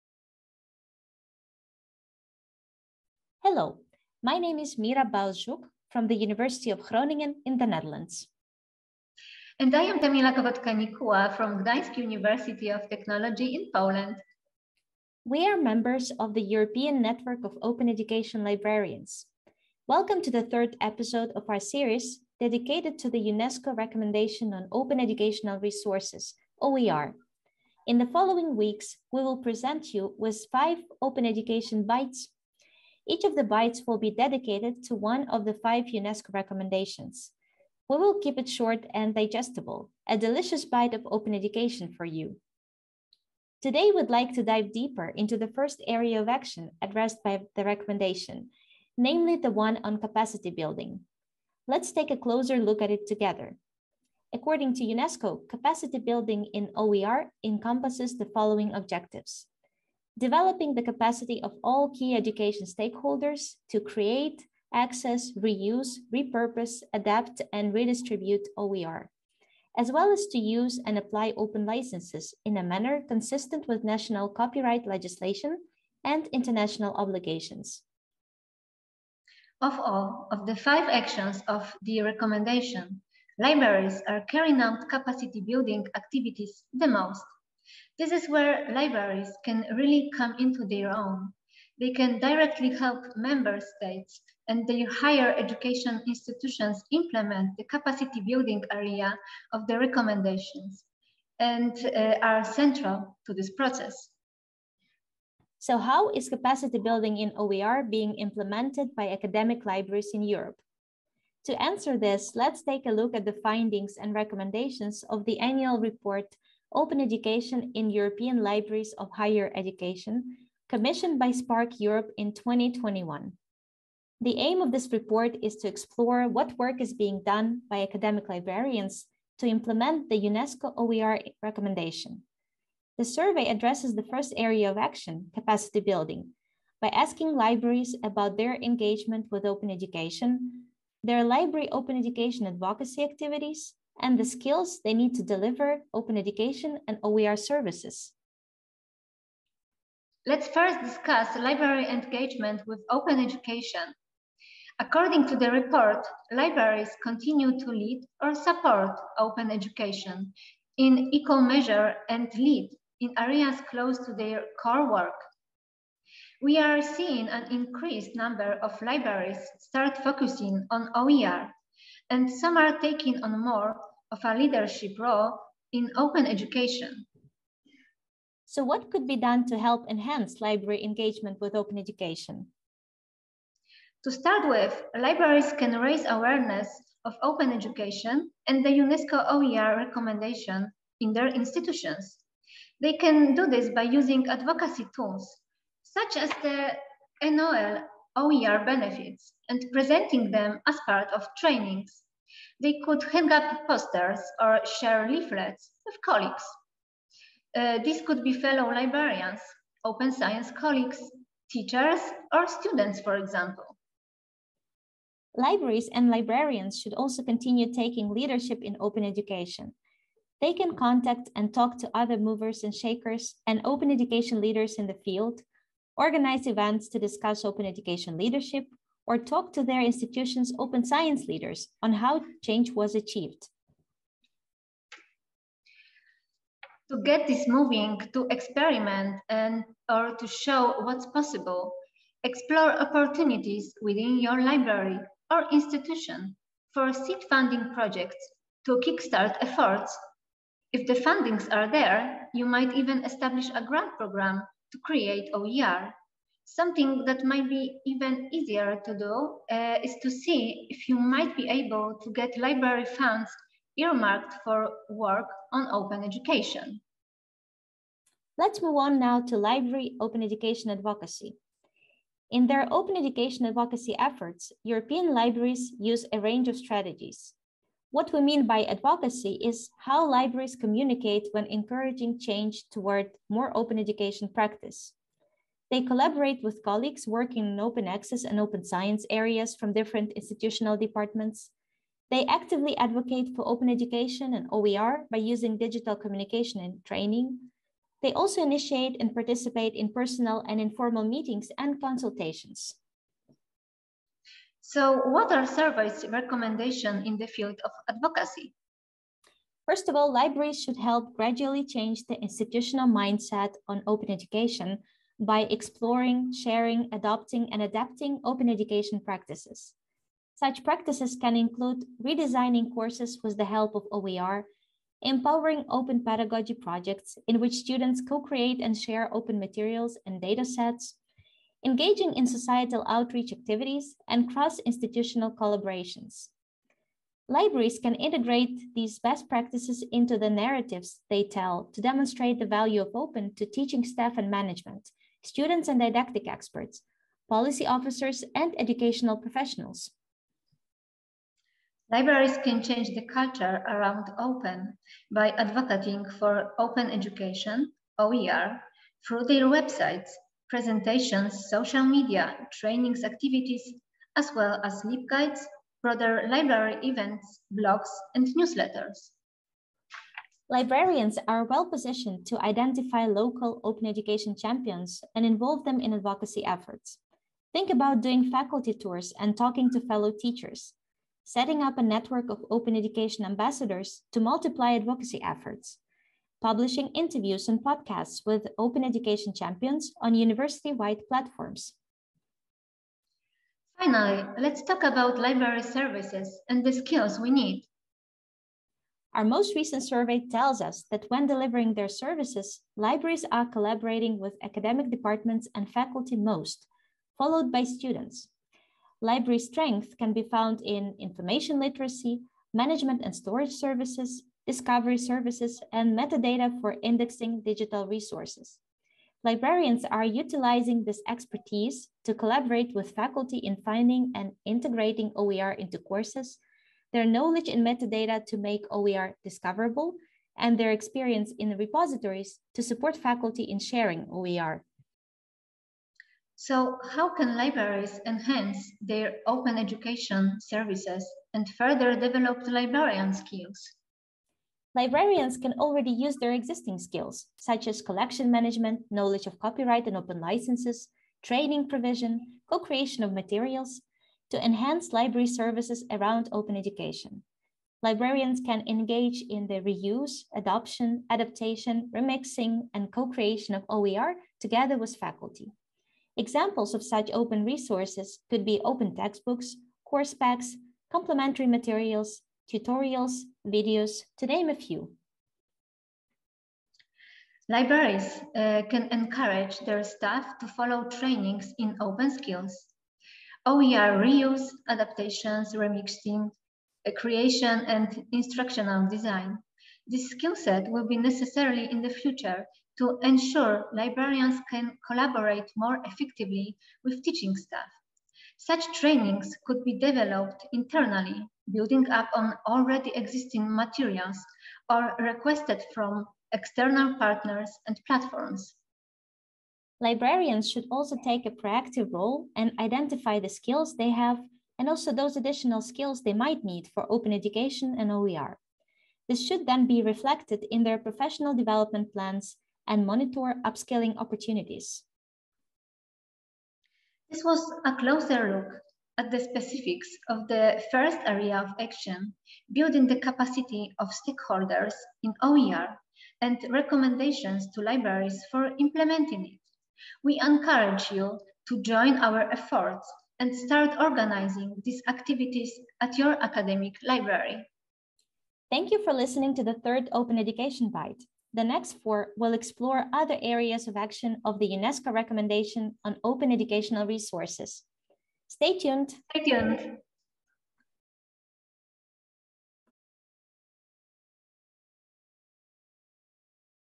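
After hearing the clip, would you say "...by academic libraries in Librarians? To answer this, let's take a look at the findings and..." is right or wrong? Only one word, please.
wrong.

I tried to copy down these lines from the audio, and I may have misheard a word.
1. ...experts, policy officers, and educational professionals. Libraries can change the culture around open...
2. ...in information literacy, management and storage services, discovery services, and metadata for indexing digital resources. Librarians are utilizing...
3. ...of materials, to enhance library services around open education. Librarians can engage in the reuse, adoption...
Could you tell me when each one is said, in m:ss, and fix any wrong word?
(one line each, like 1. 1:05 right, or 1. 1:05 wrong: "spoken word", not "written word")
1. 5:46 right
2. 6:50 right
3. 7:33 right.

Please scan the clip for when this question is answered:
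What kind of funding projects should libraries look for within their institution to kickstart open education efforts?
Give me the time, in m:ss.
4:06.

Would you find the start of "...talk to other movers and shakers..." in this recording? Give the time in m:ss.
3:41.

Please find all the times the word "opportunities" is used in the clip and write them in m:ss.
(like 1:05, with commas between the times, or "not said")
4:02, 8:43.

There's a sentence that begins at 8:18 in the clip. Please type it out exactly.
Such trainings could be developed internally, building up on already existing materials or requested from external partners and platforms.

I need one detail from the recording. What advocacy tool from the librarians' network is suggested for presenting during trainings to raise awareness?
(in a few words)
ENOEL OER benefits.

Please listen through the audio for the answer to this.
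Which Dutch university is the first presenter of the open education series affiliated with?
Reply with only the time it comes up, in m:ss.
0:06.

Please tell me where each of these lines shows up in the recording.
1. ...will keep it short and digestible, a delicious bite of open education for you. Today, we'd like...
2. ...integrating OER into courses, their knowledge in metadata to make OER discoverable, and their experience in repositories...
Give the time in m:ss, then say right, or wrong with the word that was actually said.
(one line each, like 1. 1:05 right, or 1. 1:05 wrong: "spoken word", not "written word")
1. 0:37 right
2. 7:04 right.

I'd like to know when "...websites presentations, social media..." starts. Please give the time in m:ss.
5:59.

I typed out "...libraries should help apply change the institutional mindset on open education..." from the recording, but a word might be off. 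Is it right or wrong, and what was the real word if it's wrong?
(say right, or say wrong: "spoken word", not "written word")
wrong: "gradually", not "apply".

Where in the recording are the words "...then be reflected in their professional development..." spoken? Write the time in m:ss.
8:39.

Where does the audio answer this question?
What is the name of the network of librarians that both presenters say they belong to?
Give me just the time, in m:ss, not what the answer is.
0:16.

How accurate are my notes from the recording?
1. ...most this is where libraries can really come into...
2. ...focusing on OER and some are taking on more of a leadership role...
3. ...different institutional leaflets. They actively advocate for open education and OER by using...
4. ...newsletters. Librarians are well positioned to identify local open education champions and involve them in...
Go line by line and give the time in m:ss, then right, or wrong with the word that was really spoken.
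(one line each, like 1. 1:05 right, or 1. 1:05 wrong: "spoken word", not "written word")
1. 1:26 right
2. 2:50 right
3. 4:49 wrong: "departments", not "leaflets"
4. 6:08 right.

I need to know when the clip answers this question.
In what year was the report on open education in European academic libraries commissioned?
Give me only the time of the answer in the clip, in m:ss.
2:02.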